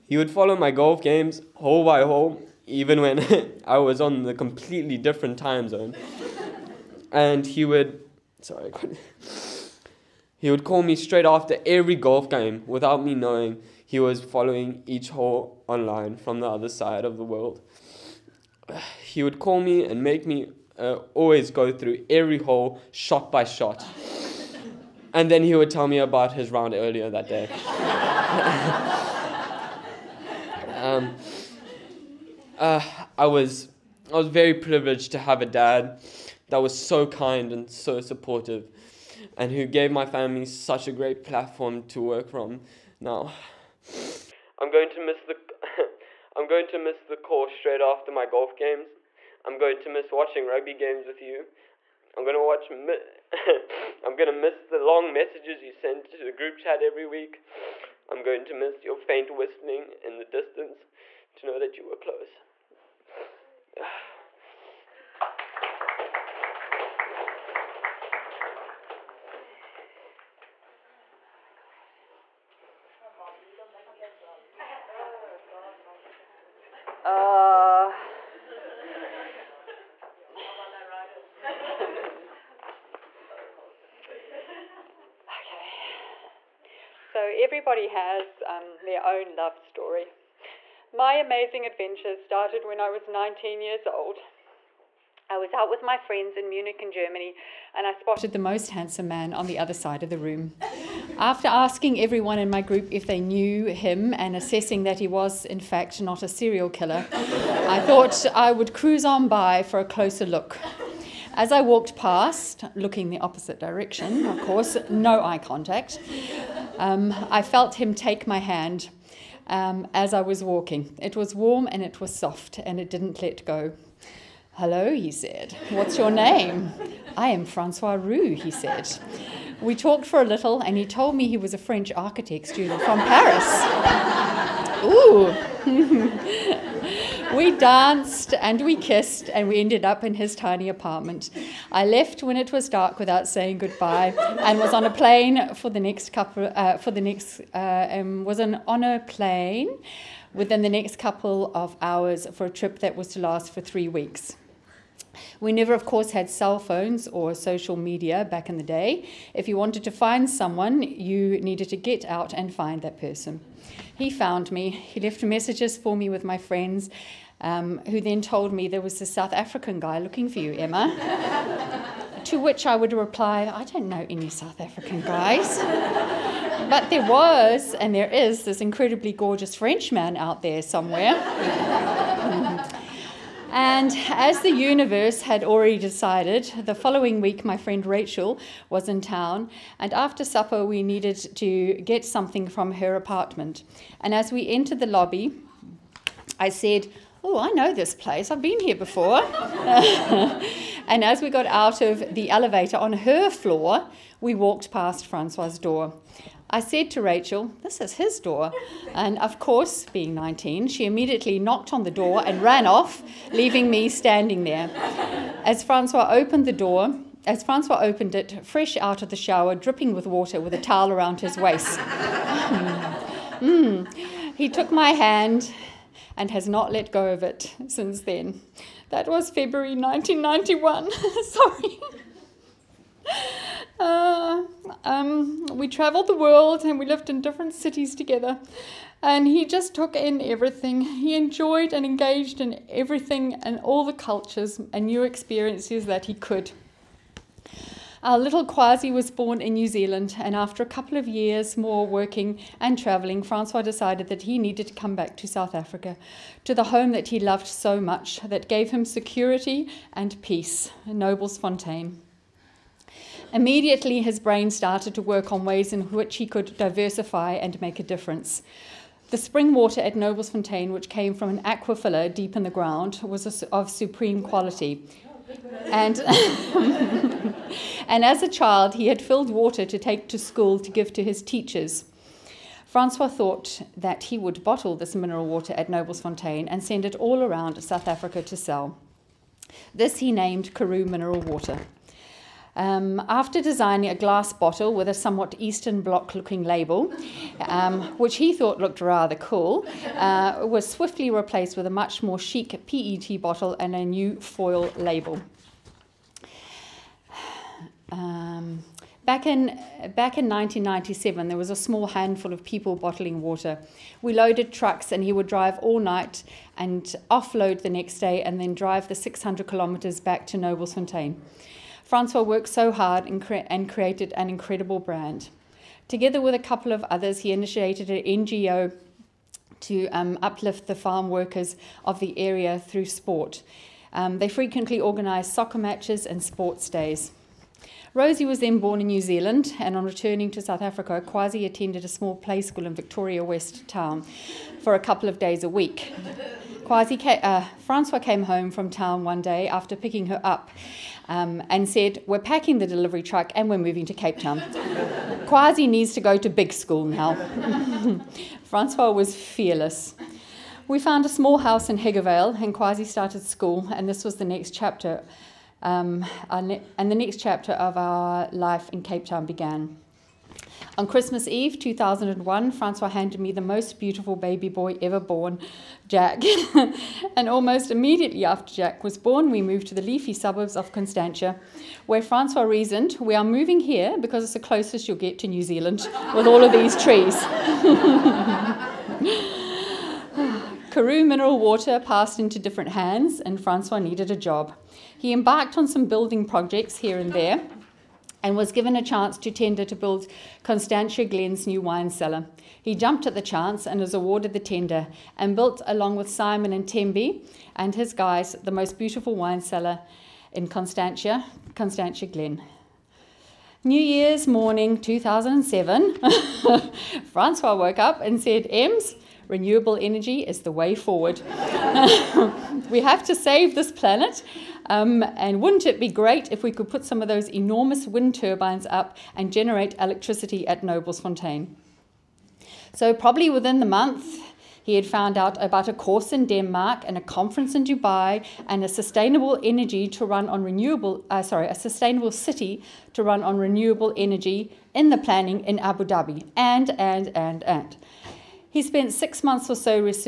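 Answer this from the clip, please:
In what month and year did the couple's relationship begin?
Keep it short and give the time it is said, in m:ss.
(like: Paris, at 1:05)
February 1991, at 3:49.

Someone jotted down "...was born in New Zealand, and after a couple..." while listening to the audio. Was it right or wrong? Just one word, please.
right.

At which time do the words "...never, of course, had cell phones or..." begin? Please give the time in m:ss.
2:35.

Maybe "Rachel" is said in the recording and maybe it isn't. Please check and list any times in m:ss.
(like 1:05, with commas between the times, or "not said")
3:07, 3:27.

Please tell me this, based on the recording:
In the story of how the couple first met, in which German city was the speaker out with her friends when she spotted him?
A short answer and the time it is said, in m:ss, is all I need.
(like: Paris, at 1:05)
Munich, at 1:36.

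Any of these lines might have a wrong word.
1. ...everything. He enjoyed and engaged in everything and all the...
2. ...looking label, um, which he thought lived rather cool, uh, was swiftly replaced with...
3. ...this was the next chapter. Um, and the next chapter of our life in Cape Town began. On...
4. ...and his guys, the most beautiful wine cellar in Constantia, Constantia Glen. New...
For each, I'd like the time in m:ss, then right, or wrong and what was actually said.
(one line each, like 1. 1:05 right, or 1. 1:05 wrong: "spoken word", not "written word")
1. 4:00 right
2. 4:56 wrong: "looked", not "lived"
3. 6:03 right
4. 6:47 right.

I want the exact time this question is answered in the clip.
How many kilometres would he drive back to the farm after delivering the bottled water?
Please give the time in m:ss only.
5:18.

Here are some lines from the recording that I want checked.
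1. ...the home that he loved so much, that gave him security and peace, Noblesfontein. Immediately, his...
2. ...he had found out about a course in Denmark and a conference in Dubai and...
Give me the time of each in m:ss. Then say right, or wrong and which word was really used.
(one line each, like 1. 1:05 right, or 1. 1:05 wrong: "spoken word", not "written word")
1. 4:16 right
2. 7:14 right.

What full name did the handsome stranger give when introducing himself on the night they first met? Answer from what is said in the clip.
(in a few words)
Francois Roux.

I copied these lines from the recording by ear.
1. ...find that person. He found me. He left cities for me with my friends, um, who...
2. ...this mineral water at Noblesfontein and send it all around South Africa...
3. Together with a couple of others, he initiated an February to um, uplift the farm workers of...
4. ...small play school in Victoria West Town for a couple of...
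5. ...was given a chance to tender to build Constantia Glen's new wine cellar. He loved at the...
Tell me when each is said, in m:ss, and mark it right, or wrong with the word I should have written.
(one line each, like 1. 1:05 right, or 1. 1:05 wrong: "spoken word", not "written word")
1. 2:42 wrong: "messages", not "cities"
2. 4:44 right
3. 5:25 wrong: "NGO", not "February"
4. 5:41 right
5. 6:38 wrong: "jumped", not "loved".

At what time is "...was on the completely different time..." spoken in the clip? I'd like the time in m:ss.
0:03.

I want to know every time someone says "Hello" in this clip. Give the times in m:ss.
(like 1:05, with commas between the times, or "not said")
2:04.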